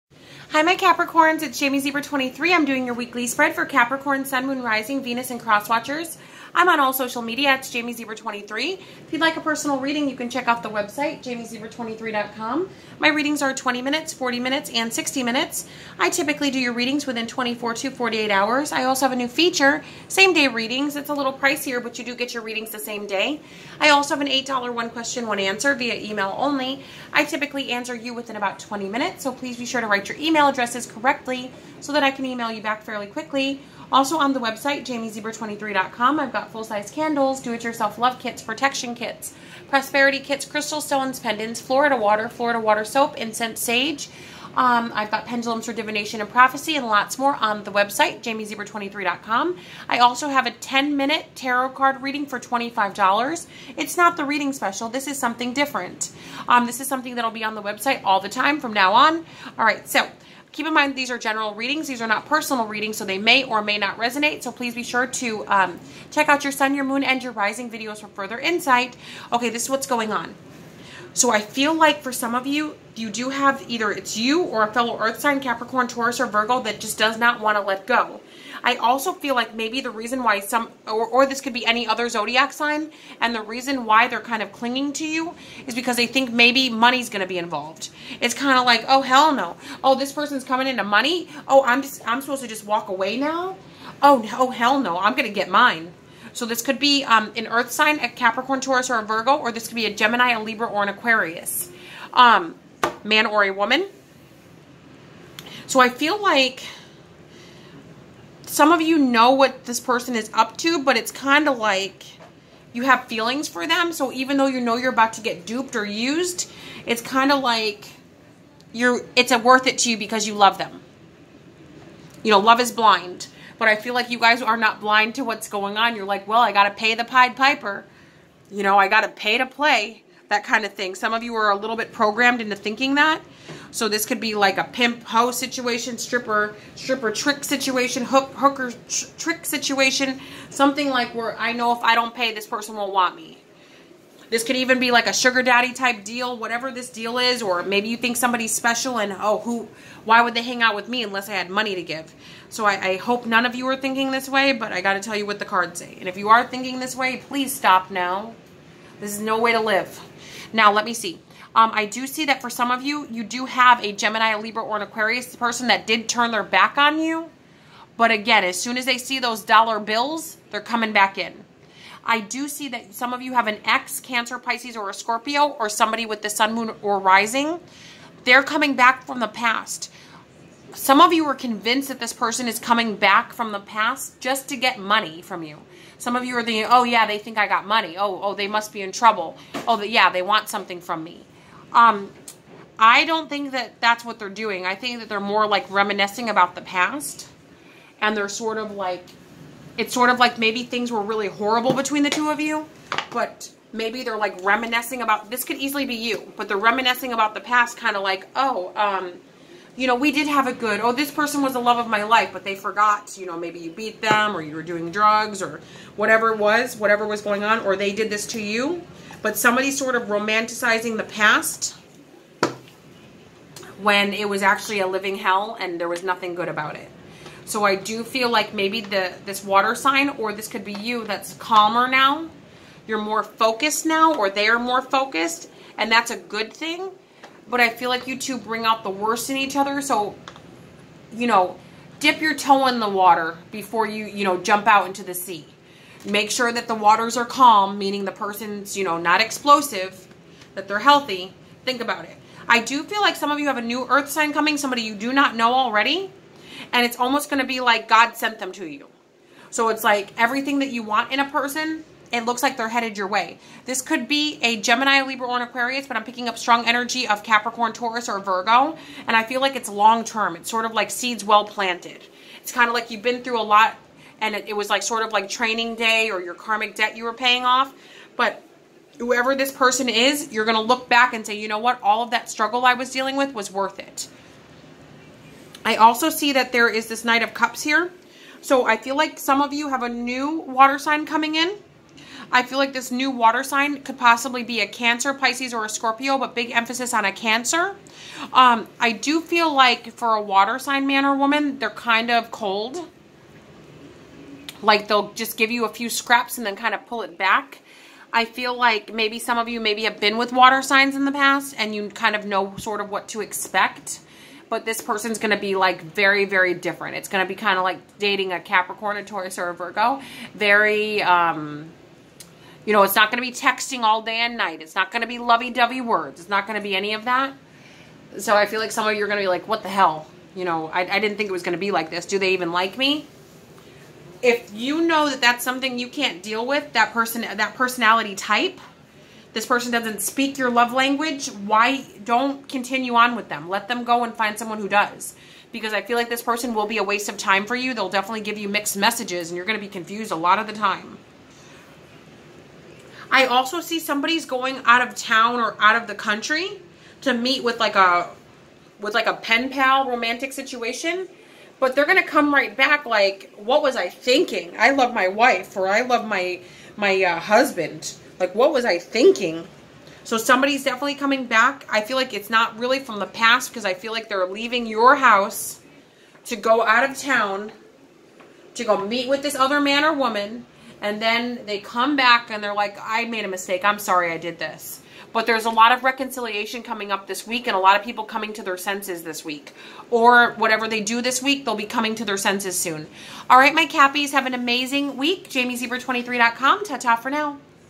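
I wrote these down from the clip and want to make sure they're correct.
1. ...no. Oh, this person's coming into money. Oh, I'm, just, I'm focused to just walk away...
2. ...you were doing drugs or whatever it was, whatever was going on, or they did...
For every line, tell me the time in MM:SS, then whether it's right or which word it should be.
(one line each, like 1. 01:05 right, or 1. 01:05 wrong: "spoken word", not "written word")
1. 01:29 wrong: "supposed", not "focused"
2. 03:34 right.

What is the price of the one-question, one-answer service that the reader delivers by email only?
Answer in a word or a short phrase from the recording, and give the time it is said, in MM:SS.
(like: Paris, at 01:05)
$8, at 00:24.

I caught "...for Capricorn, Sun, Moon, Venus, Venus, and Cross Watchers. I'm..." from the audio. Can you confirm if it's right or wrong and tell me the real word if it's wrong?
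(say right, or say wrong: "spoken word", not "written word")
wrong: "Rising", not "Venus".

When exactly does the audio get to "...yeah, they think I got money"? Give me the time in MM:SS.
03:06.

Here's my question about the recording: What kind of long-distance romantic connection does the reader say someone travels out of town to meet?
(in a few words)
pen pal.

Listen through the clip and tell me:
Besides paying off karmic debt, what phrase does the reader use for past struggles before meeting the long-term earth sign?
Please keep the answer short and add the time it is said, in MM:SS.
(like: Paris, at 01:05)
training day, at 04:35.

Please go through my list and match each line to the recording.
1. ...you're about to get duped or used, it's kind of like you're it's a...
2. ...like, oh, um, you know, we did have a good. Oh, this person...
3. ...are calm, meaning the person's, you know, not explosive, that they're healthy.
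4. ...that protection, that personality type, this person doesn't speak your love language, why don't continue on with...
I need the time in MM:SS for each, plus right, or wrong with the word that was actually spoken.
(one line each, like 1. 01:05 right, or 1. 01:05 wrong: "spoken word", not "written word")
1. 01:54 right
2. 03:28 right
3. 04:07 right
4. 05:36 wrong: "person", not "protection".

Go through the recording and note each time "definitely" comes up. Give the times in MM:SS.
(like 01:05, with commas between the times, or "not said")
05:47, 06:10.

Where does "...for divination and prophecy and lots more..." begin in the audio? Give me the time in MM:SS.
00:45.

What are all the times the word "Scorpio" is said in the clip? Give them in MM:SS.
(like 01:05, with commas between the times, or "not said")
02:54, 04:55.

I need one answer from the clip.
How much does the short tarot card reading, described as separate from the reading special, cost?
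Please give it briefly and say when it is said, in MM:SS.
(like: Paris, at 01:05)
$25, at 00:52.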